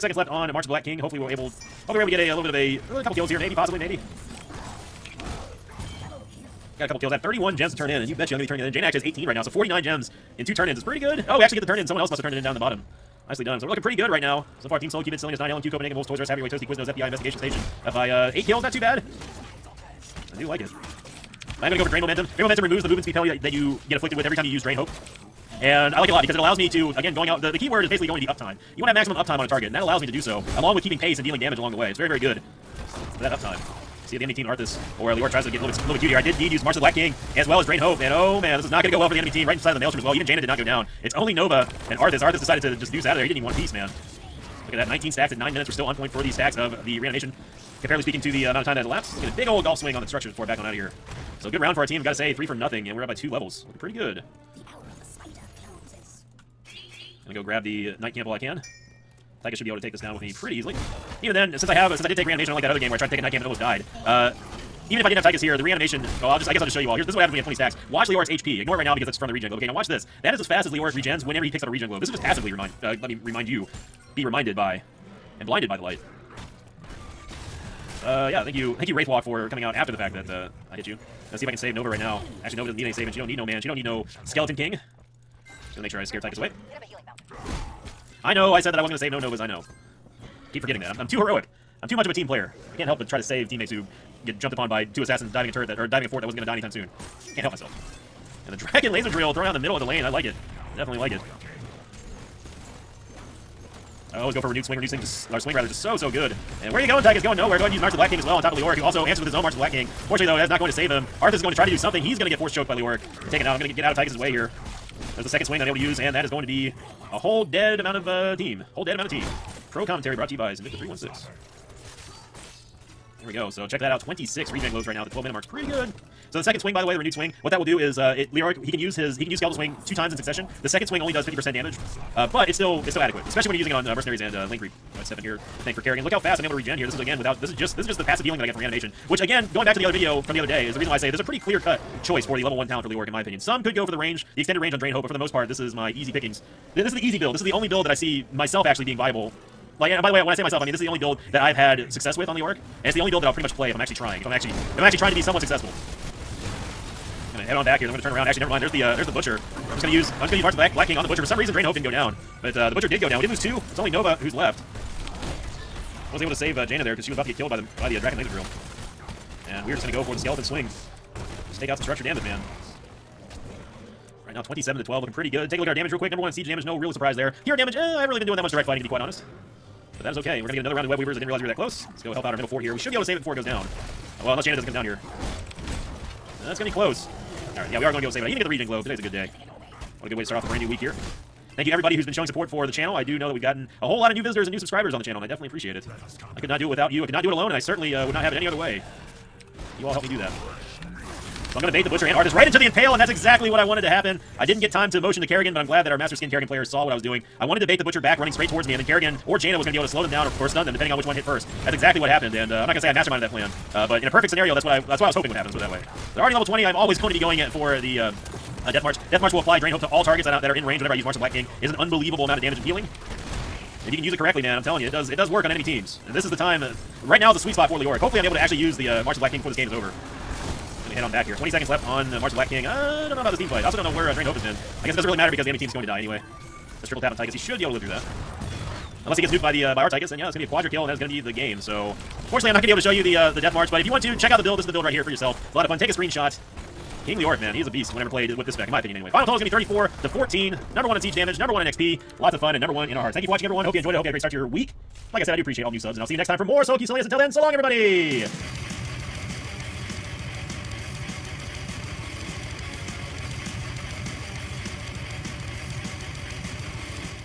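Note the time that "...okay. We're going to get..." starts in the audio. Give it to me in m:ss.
3:00.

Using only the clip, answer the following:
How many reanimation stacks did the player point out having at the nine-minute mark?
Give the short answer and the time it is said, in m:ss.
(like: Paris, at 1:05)
19, at 0:44.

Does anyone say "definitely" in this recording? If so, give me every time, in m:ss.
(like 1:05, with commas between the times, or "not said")
1:40, 3:15.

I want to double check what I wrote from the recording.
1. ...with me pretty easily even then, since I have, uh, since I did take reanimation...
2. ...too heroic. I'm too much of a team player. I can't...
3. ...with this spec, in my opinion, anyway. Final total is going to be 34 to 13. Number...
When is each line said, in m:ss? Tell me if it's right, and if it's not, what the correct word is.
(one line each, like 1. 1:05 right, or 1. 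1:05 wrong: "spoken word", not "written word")
1. 1:00 right
2. 1:31 right
3. 4:08 wrong: "14", not "13".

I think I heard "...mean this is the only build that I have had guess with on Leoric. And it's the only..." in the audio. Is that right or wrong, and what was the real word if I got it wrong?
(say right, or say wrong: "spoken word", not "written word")
wrong: "success", not "guess".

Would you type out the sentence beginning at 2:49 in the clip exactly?
And we're just gonna go for the skeleton swing.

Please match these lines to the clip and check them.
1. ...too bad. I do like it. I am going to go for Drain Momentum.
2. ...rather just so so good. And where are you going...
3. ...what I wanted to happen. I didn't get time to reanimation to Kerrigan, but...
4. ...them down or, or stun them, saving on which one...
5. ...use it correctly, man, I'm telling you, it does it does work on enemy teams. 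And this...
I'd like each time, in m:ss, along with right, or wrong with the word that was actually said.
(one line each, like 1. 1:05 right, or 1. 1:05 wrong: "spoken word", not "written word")
1. 0:18 right
2. 1:45 right
3. 3:23 wrong: "motion", not "reanimation"
4. 3:30 wrong: "depending", not "saving"
5. 3:44 right.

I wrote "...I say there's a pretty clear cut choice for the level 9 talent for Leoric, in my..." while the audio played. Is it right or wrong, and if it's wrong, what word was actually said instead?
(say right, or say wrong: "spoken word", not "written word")
wrong: "1", not "9".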